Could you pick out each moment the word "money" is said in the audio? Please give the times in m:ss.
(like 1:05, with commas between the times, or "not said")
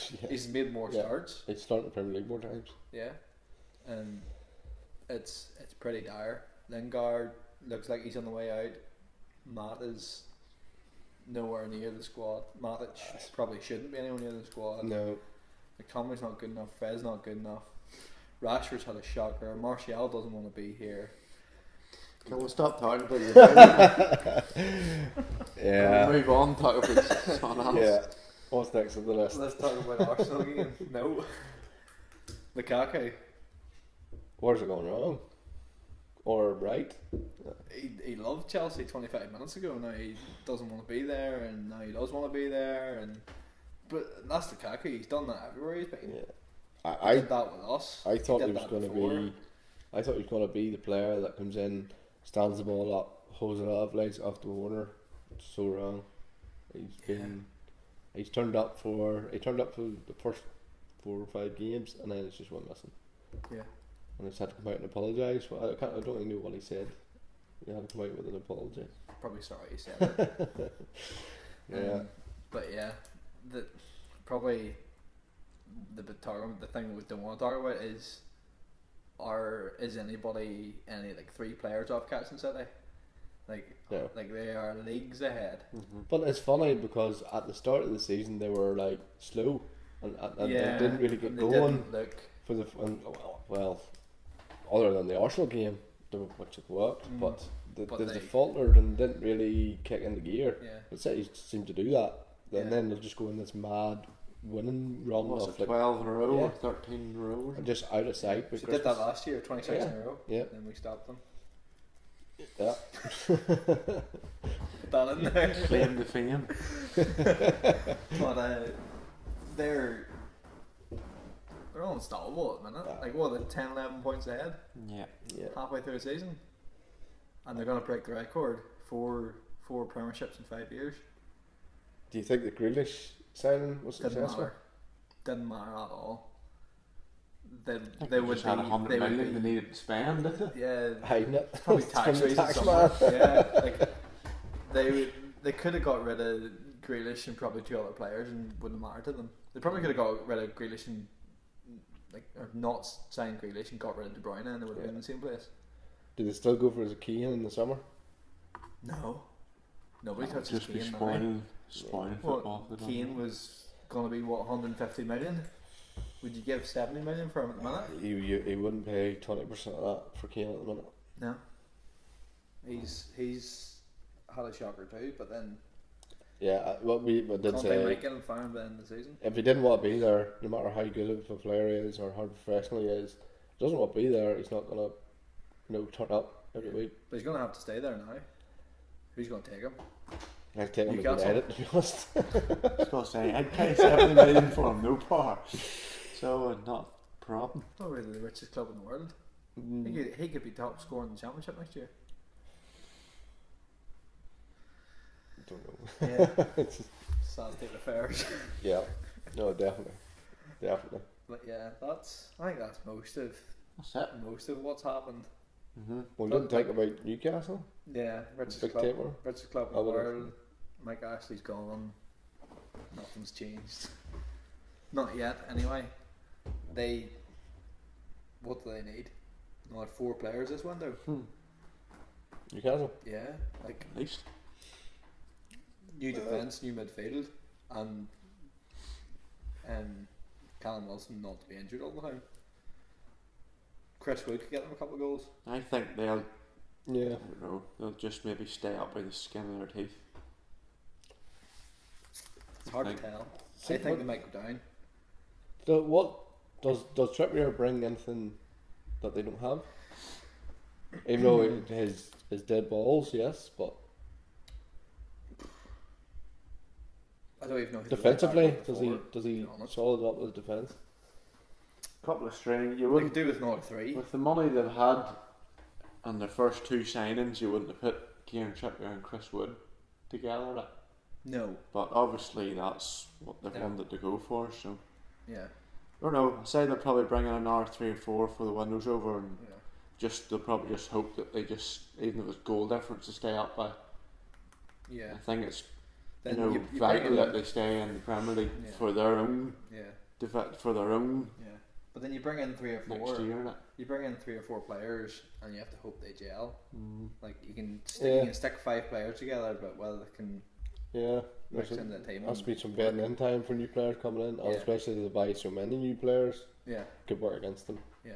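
4:34.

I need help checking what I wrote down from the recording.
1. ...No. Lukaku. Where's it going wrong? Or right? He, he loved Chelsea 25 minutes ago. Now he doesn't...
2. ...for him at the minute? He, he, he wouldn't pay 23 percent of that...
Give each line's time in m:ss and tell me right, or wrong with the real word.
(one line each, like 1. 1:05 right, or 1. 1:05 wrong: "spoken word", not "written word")
1. 0:30 right
2. 2:47 wrong: "20", not "23".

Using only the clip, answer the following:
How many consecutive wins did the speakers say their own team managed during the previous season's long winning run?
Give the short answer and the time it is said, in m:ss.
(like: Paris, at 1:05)
26, at 1:49.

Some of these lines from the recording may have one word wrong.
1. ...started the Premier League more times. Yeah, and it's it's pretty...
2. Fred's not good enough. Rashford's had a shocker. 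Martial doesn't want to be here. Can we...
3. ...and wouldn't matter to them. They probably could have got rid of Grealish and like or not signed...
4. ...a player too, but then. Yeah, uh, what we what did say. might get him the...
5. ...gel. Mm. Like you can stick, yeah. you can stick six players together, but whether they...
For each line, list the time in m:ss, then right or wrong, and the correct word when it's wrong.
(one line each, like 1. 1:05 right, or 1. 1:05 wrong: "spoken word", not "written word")
1. 0:01 right
2. 0:16 right
3. 2:28 right
4. 2:54 wrong: "shocker", not "player"
5. 5:06 wrong: "five", not "six".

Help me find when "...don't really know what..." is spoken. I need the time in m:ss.
1:05.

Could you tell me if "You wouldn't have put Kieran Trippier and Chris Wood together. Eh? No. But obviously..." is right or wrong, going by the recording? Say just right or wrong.
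right.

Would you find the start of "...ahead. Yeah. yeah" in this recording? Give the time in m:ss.
2:04.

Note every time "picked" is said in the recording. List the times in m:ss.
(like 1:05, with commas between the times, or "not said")
not said.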